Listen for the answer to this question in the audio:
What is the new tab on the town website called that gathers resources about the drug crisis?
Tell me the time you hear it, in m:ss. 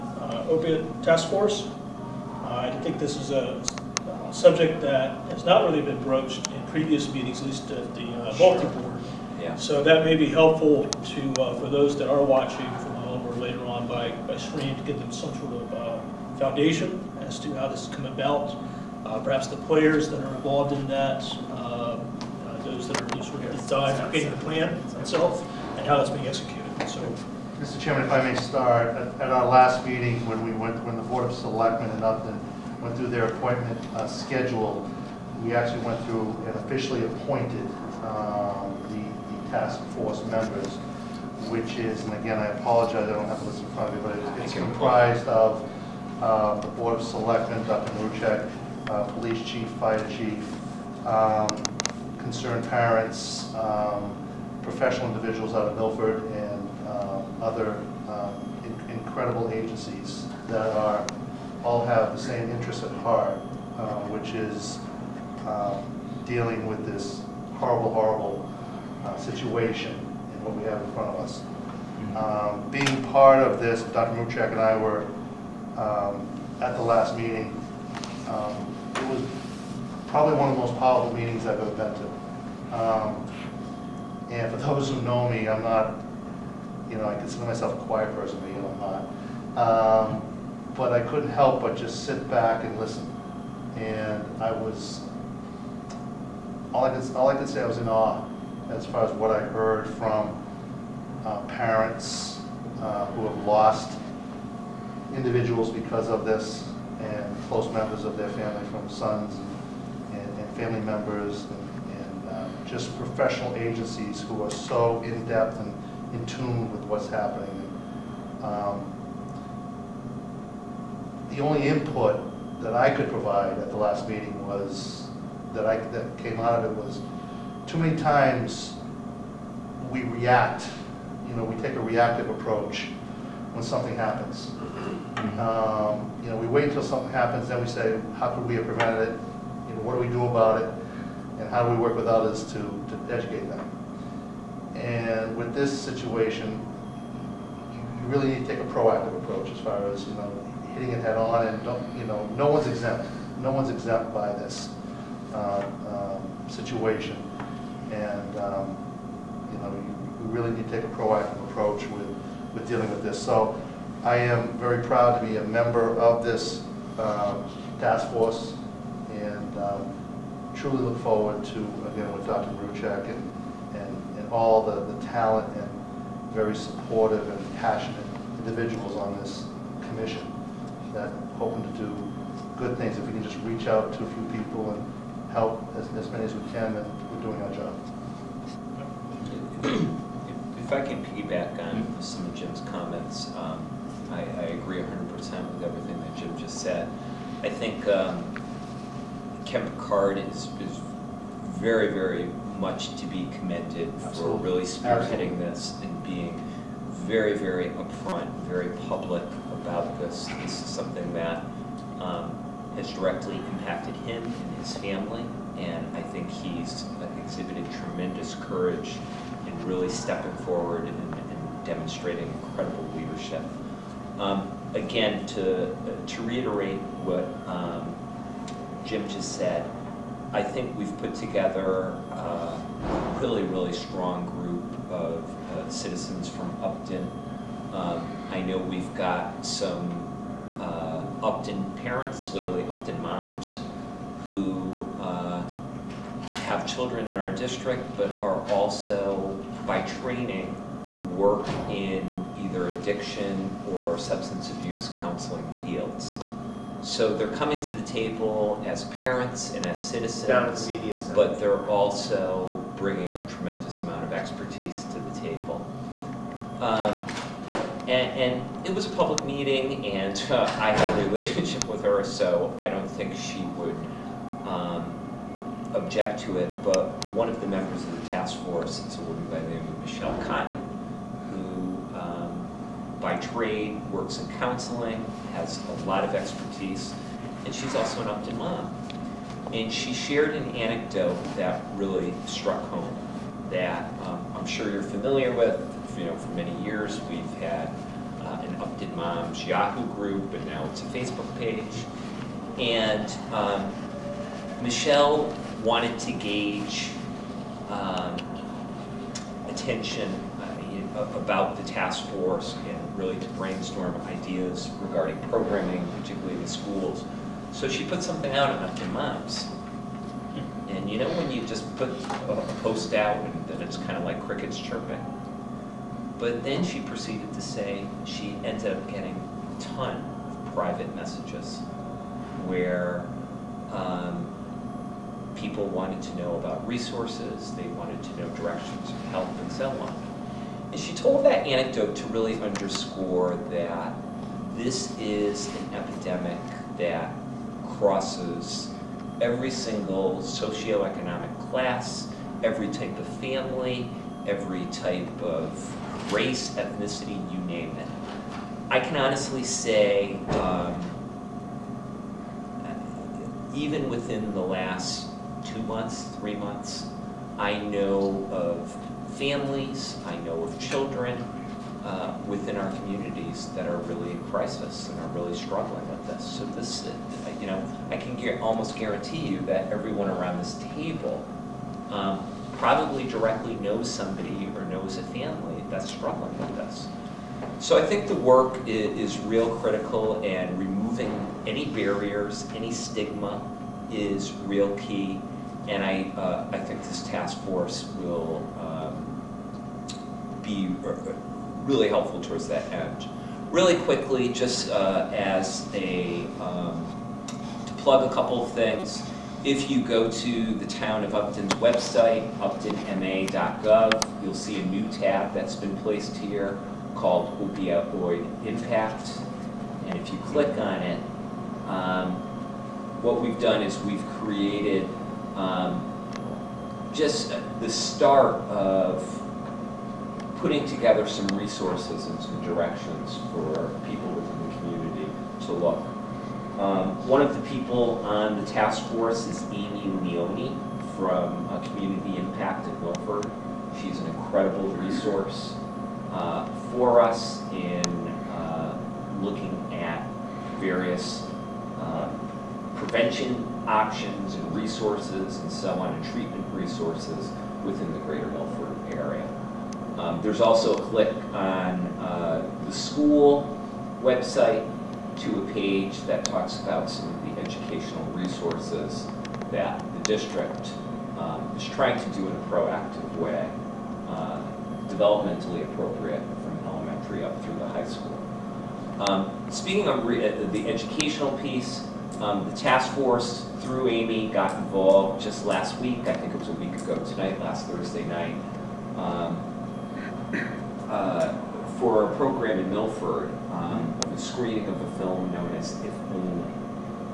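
6:57.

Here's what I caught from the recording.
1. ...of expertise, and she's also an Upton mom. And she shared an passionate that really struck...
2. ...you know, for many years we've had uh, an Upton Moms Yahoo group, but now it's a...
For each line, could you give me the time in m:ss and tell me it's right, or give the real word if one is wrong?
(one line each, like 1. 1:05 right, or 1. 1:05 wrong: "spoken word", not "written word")
1. 4:46 wrong: "anecdote", not "passionate"
2. 4:55 right.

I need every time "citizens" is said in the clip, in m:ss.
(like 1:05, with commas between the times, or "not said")
3:55, 4:19.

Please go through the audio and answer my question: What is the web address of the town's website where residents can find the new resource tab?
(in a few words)
uptonma.gov.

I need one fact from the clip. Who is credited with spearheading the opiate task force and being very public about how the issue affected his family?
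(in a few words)
Ken Picard.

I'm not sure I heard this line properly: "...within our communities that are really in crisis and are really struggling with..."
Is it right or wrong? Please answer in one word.
right.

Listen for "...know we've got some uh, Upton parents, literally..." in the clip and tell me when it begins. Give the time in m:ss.
3:58.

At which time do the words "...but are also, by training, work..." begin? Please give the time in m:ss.
4:07.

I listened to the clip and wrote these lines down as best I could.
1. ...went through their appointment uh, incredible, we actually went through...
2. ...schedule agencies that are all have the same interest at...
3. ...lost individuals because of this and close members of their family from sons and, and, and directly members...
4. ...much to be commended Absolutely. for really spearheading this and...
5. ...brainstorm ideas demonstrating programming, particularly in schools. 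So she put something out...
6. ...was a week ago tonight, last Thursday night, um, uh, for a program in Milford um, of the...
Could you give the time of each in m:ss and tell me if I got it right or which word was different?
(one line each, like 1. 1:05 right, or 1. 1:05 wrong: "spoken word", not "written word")
1. 0:32 wrong: "schedule", not "incredible"
2. 0:58 wrong: "incredible", not "schedule"
3. 1:43 wrong: "family", not "directly"
4. 3:22 right
5. 5:13 wrong: "regarding", not "demonstrating"
6. 8:06 right.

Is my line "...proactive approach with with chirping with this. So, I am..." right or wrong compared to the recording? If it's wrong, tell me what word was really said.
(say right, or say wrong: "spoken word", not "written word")
wrong: "dealing", not "chirping".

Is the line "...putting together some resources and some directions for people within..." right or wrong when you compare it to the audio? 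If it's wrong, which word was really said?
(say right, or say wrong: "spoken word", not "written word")
right.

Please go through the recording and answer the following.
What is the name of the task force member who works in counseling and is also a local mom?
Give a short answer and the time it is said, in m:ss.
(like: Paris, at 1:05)
Michelle Cotton, at 4:39.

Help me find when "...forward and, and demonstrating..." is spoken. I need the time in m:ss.
3:40.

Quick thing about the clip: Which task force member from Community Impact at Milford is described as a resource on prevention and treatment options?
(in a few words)
Amy Leone.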